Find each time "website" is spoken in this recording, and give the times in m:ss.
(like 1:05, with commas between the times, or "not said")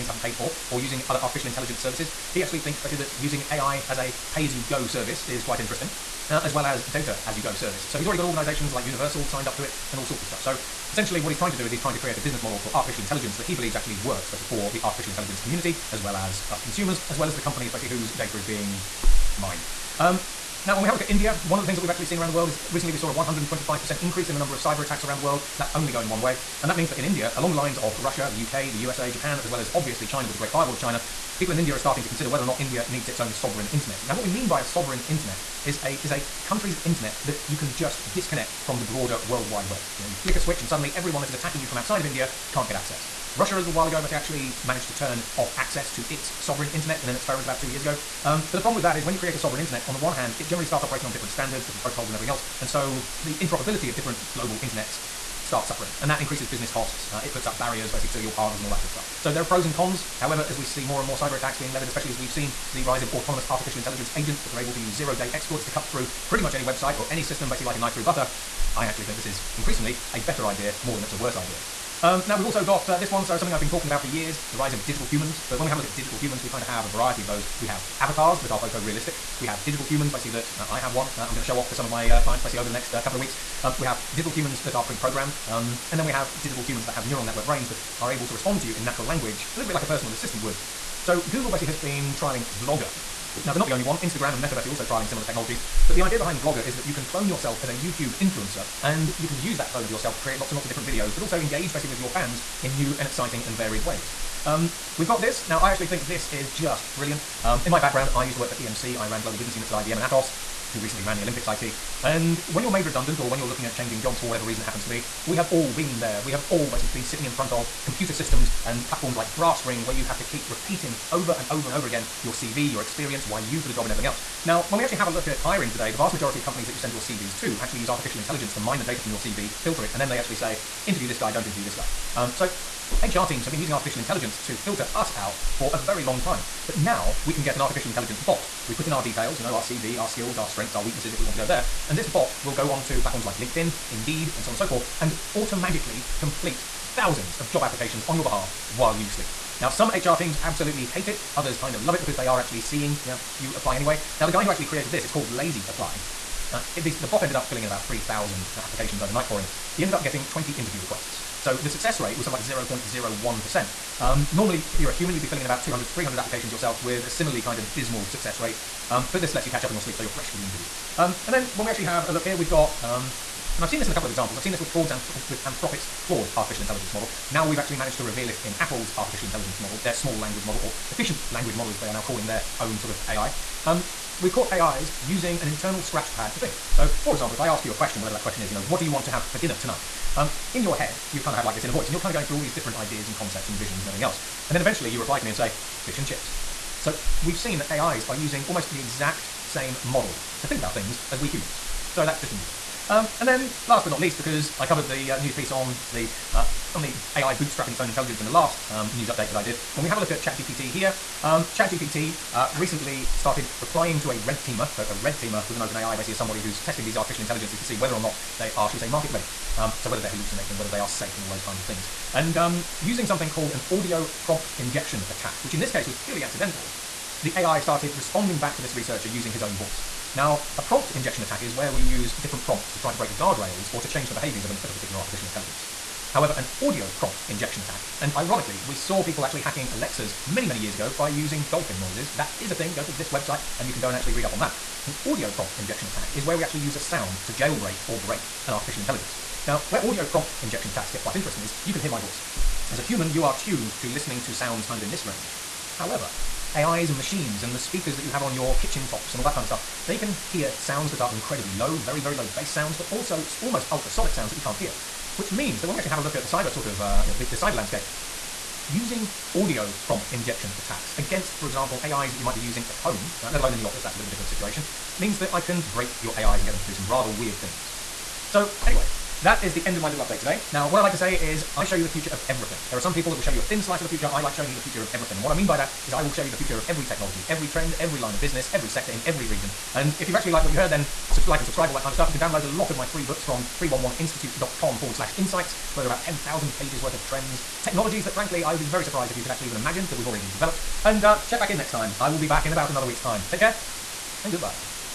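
1:06, 4:03.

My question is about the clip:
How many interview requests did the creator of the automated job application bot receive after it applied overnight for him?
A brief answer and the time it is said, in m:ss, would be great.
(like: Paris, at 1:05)
20, at 2:40.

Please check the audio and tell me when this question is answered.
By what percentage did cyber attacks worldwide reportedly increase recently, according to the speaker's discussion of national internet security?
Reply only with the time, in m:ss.
0:23.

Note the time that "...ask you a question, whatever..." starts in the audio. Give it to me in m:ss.
3:07.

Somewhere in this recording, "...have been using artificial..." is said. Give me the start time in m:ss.
2:13.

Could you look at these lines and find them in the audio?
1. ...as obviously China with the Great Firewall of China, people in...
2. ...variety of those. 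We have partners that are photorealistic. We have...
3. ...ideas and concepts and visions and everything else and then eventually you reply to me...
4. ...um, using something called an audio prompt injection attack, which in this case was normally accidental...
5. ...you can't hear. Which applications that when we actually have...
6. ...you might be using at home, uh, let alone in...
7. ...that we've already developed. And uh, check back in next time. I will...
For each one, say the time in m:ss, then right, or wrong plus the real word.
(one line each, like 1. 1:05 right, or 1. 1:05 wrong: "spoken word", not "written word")
1. 0:29 right
2. 1:16 wrong: "avatars", not "partners"
3. 3:12 right
4. 3:42 wrong: "purely", not "normally"
5. 4:24 wrong: "means", not "applications"
6. 4:32 right
7. 4:59 right.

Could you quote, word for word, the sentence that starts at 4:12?
As a human, you are tuned to listening to sounds kind of in this range.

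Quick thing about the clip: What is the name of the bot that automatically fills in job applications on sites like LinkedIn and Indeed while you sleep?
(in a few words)
Lazy Apply.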